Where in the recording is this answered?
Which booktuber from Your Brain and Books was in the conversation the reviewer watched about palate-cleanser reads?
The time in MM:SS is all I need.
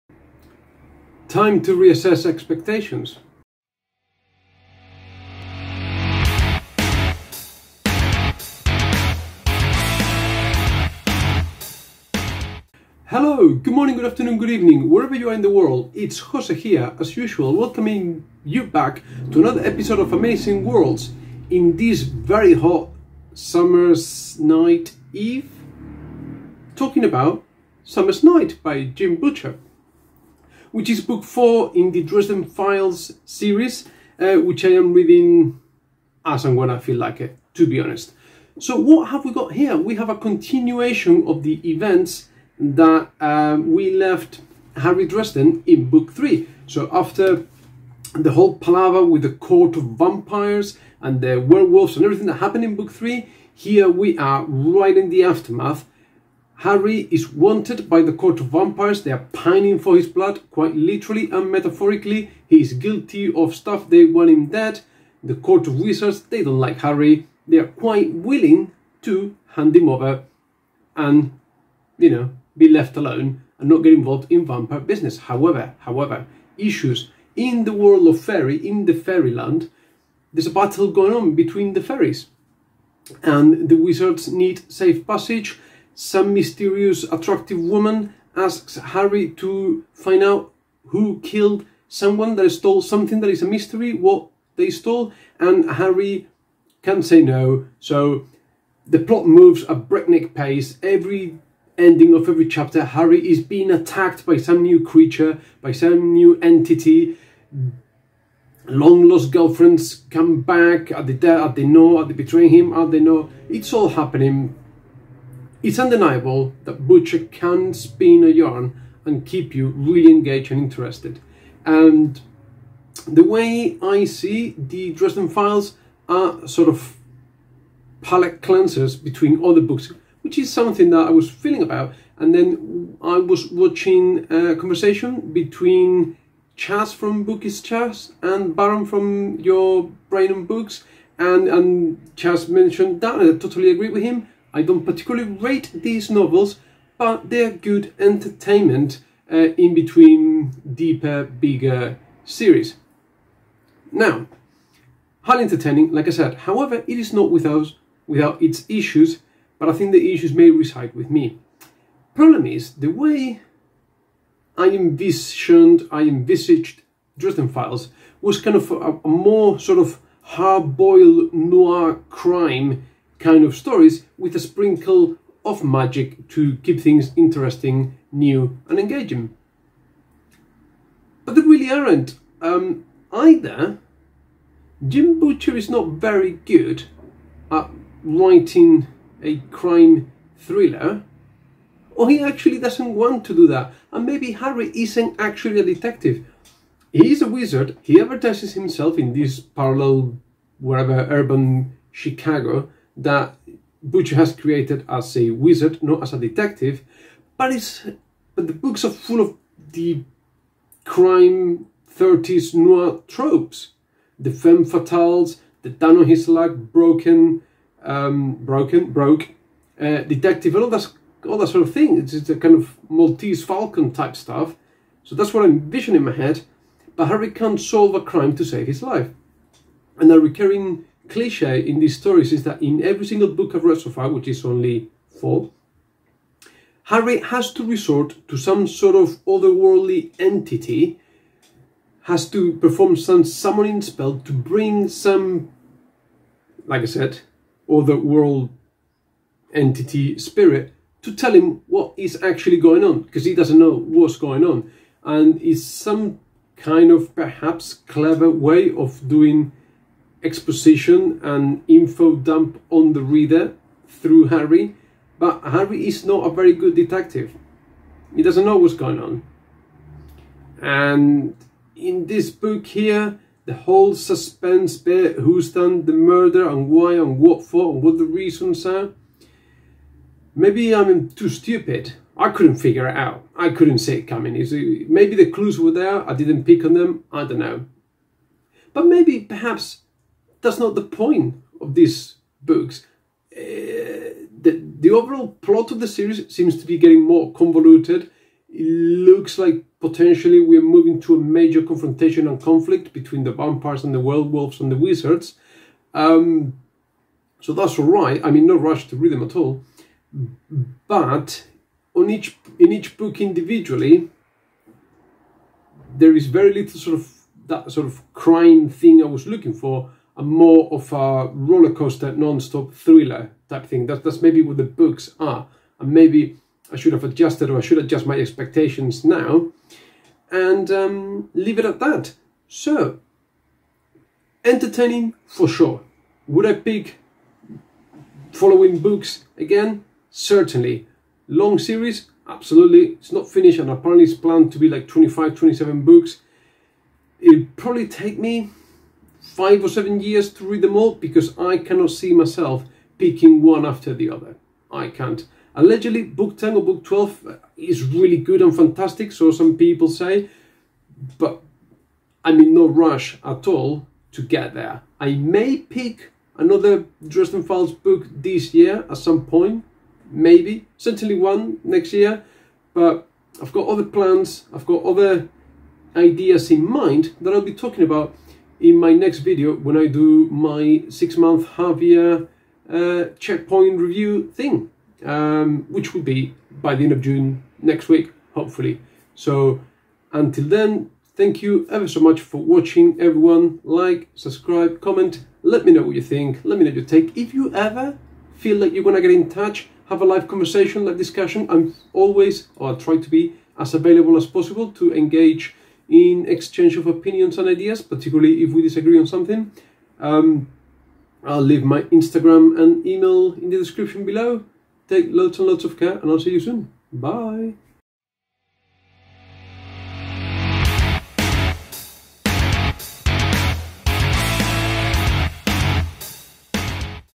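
02:18.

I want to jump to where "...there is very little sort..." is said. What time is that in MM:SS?
05:15.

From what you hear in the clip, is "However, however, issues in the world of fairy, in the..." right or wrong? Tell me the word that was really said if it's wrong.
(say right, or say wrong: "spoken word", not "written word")
right.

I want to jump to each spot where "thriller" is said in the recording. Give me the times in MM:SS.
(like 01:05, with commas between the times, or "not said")
03:10, 05:22.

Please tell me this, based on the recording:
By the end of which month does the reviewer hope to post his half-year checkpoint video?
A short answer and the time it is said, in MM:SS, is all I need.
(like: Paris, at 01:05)
June, at 06:27.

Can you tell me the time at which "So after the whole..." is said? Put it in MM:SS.
00:46.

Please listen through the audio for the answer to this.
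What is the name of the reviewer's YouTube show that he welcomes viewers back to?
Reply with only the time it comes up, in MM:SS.
00:20.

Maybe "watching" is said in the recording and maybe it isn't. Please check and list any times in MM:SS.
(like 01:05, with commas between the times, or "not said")
02:13, 06:32.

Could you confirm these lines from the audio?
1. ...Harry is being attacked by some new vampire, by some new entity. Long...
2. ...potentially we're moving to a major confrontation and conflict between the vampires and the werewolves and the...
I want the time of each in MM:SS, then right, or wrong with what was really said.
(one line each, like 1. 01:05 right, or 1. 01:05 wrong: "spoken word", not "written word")
1. 01:42 wrong: "creature", not "vampire"
2. 04:59 right.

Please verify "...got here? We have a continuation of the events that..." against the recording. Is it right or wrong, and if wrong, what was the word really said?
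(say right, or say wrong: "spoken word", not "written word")
right.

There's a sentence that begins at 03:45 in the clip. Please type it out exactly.
So that's what I envision in my head.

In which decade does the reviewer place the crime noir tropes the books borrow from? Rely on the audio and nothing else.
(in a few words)
1930s.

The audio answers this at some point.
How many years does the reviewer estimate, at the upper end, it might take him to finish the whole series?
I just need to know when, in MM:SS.
05:49.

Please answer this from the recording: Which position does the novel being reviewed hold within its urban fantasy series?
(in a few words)
Book 4.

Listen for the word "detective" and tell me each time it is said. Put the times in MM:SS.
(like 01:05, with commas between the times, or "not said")
03:15, 03:26, 03:40, 04:26.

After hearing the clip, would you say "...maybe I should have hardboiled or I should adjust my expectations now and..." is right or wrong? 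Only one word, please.
wrong.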